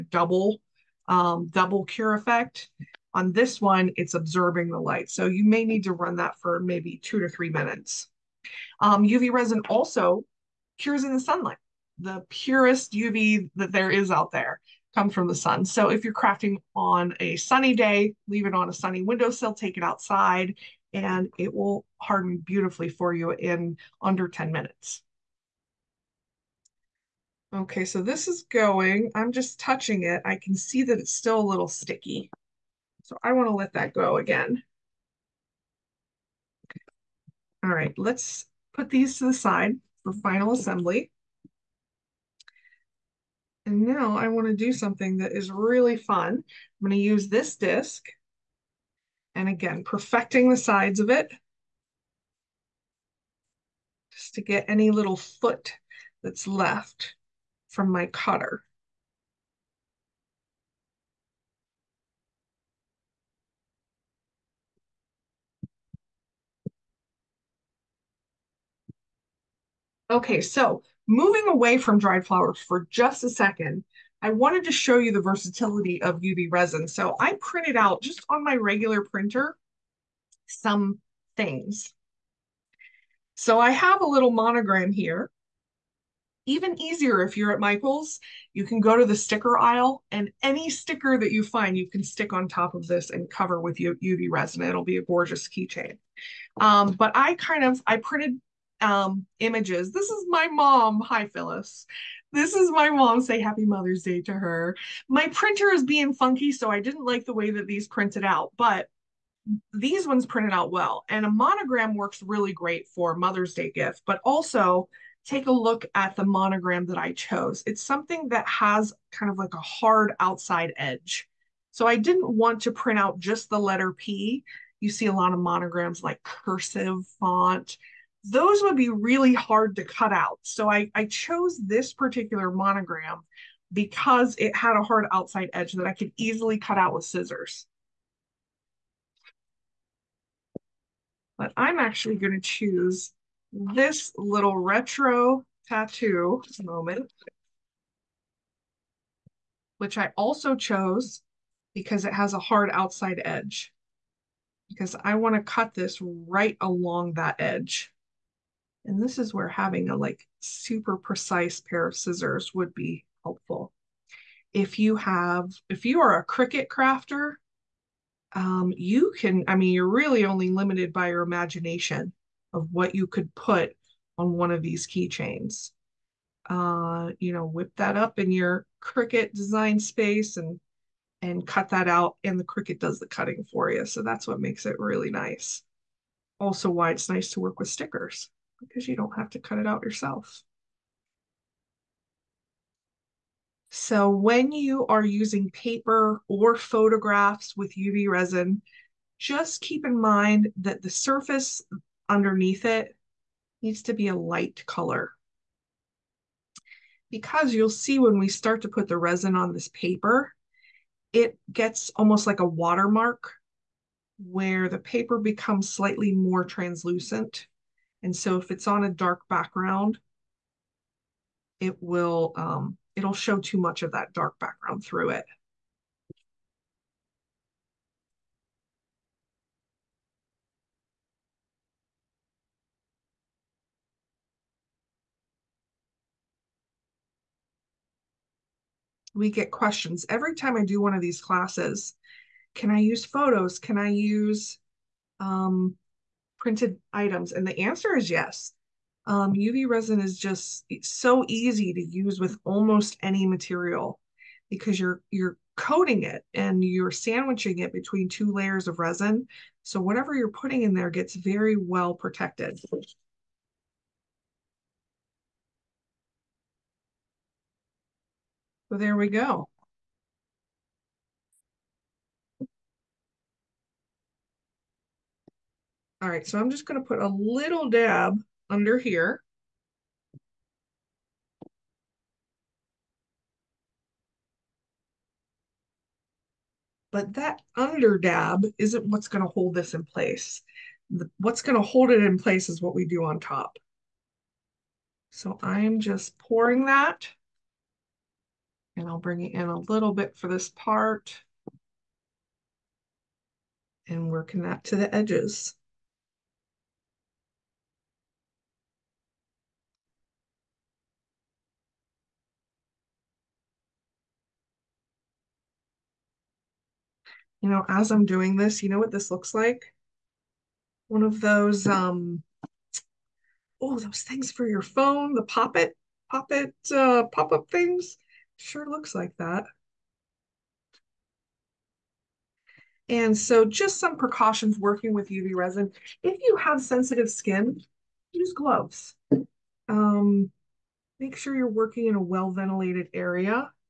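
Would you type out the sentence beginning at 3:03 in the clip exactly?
So that's what makes it really nice.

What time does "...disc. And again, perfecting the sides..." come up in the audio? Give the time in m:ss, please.
0:47.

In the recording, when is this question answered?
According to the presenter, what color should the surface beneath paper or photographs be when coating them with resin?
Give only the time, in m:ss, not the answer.
3:24.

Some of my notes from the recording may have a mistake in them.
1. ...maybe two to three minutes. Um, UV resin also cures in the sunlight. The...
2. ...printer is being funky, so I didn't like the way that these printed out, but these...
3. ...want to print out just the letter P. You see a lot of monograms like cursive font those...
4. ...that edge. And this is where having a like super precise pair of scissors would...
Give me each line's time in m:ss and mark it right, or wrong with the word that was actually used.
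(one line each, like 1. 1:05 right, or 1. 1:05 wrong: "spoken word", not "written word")
1. 0:06 right
2. 1:45 right
3. 2:02 right
4. 2:37 right.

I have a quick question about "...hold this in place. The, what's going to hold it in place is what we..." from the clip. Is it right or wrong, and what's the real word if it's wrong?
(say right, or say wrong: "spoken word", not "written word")
right.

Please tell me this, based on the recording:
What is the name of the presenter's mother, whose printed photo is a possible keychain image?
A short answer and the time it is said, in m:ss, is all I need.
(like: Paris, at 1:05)
Phyllis, at 1:41.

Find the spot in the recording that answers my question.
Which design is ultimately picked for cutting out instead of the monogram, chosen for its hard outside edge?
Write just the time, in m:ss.
2:24.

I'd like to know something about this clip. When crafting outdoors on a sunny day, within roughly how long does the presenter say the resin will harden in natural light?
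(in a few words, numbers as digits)
under 10 minutes.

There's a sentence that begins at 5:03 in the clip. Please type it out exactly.
And working that to the edges.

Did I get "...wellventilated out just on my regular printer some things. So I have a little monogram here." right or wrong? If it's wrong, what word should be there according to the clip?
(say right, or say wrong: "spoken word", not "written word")
wrong: "printed", not "wellventilated".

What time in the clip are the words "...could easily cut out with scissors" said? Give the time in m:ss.
2:15.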